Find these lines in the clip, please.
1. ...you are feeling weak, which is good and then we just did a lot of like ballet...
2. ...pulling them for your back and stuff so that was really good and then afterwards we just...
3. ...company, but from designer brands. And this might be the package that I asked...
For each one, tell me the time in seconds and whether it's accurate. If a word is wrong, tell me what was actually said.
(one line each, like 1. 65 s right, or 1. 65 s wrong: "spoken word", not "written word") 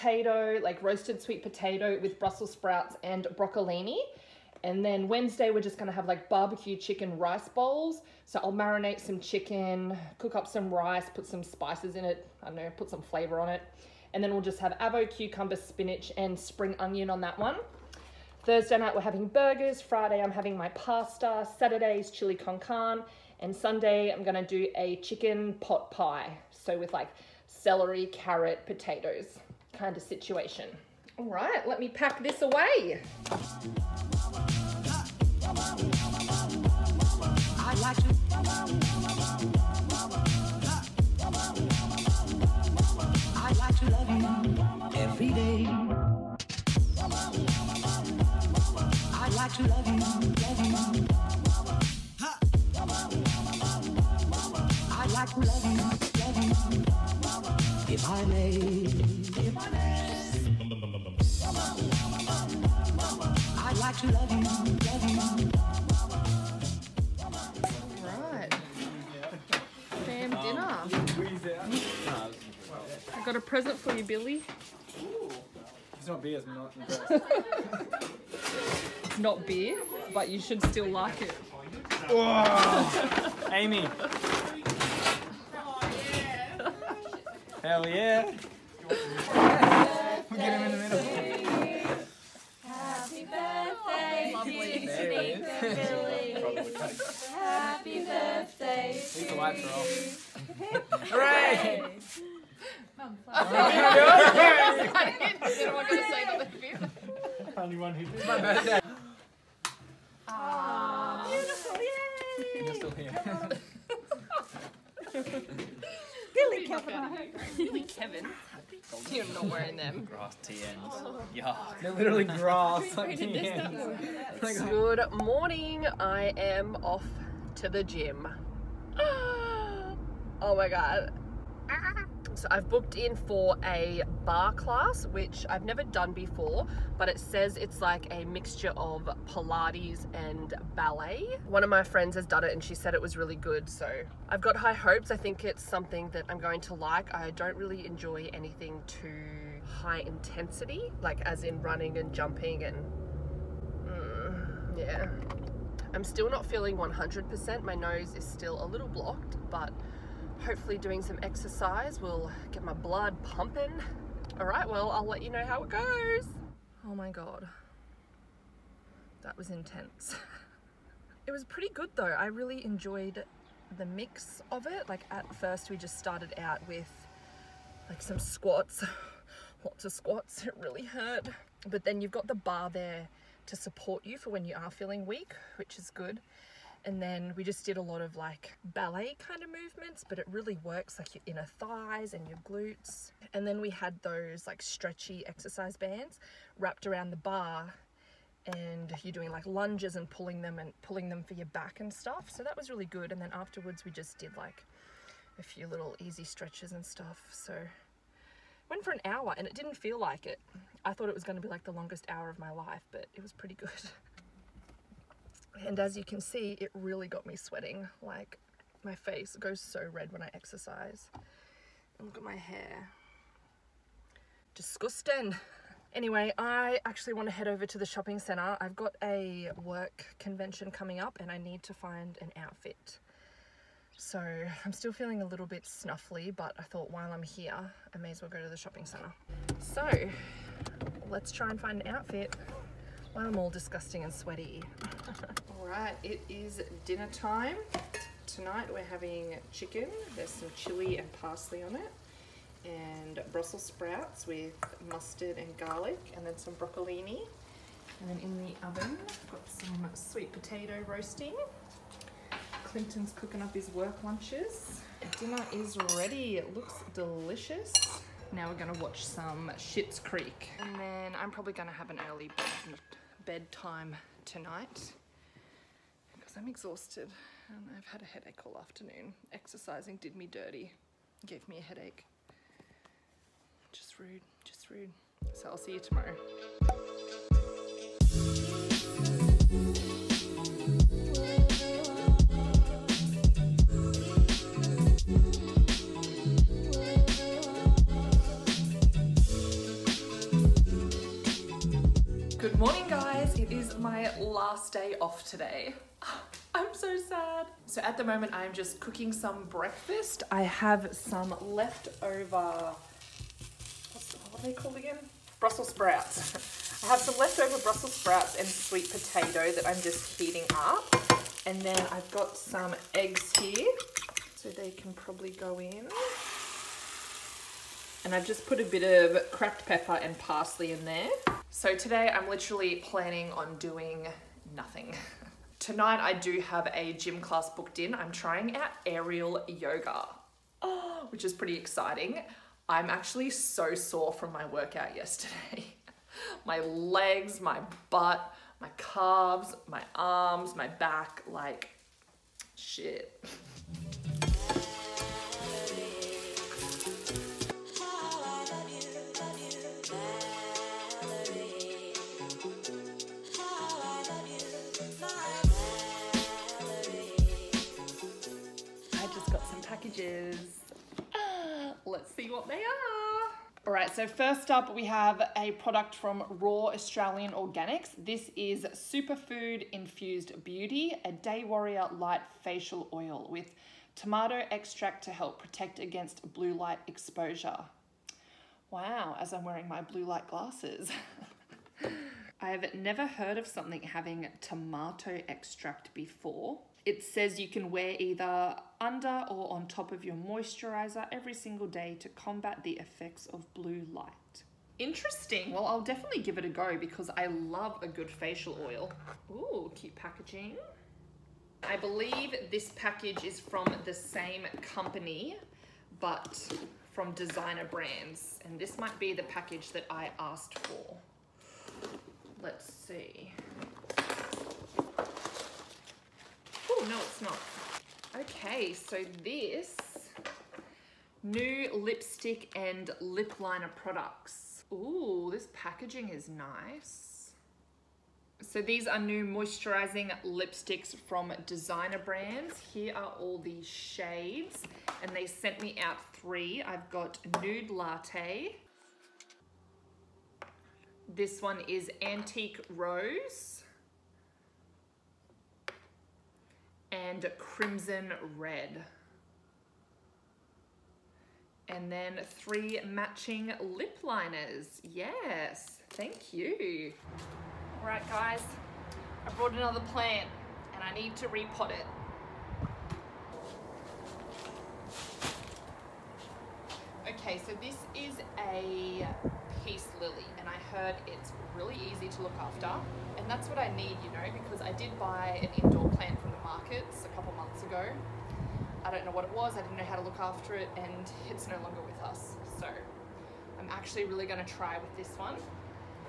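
1. 184 s right
2. 200 s right
3. 414 s right.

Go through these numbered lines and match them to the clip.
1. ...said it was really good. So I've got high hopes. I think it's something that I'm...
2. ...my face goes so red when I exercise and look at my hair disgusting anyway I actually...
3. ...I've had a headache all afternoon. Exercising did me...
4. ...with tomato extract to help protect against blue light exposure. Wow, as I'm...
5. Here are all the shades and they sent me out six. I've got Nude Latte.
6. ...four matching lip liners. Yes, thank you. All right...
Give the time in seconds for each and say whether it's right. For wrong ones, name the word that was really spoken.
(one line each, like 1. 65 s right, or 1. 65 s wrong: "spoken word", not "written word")
1. 142 s right
2. 218 s right
3. 277 s right
4. 383 s right
5. 442 s wrong: "three", not "six"
6. 462 s wrong: "three", not "four".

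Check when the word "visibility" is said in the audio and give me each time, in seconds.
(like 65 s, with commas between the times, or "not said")
not said.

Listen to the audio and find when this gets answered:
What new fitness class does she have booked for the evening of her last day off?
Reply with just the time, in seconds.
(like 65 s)
338 s.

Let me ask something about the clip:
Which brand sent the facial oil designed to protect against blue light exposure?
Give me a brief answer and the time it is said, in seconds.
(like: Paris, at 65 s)
Raw Australian Organics, at 376 s.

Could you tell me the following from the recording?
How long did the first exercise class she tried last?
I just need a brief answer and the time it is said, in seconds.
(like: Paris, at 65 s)
An hour, at 208 s.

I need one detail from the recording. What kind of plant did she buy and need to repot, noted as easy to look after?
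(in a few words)
Peace lily.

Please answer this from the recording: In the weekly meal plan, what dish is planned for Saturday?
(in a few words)
Chili con carne.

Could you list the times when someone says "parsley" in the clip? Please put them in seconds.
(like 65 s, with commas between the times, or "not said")
251 s, 330 s.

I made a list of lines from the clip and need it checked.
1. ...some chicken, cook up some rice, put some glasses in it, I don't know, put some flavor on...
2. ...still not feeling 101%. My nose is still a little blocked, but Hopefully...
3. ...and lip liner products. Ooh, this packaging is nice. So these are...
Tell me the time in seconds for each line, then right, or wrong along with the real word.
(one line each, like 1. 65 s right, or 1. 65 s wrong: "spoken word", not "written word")
1. 8 s wrong: "spices", not "glasses"
2. 156 s wrong: "100", not "101"
3. 432 s right.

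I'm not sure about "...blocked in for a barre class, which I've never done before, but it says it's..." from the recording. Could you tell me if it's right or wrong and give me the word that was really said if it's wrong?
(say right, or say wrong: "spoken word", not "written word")
wrong: "booked", not "blocked".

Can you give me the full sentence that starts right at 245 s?
all right, it is dinner time.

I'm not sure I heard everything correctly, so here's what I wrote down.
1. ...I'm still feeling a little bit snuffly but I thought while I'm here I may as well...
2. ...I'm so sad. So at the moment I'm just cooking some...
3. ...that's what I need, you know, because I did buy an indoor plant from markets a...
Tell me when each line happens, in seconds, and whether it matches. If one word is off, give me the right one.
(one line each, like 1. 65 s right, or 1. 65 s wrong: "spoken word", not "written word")
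1. 234 s right
2. 306 s right
3. 483 s right.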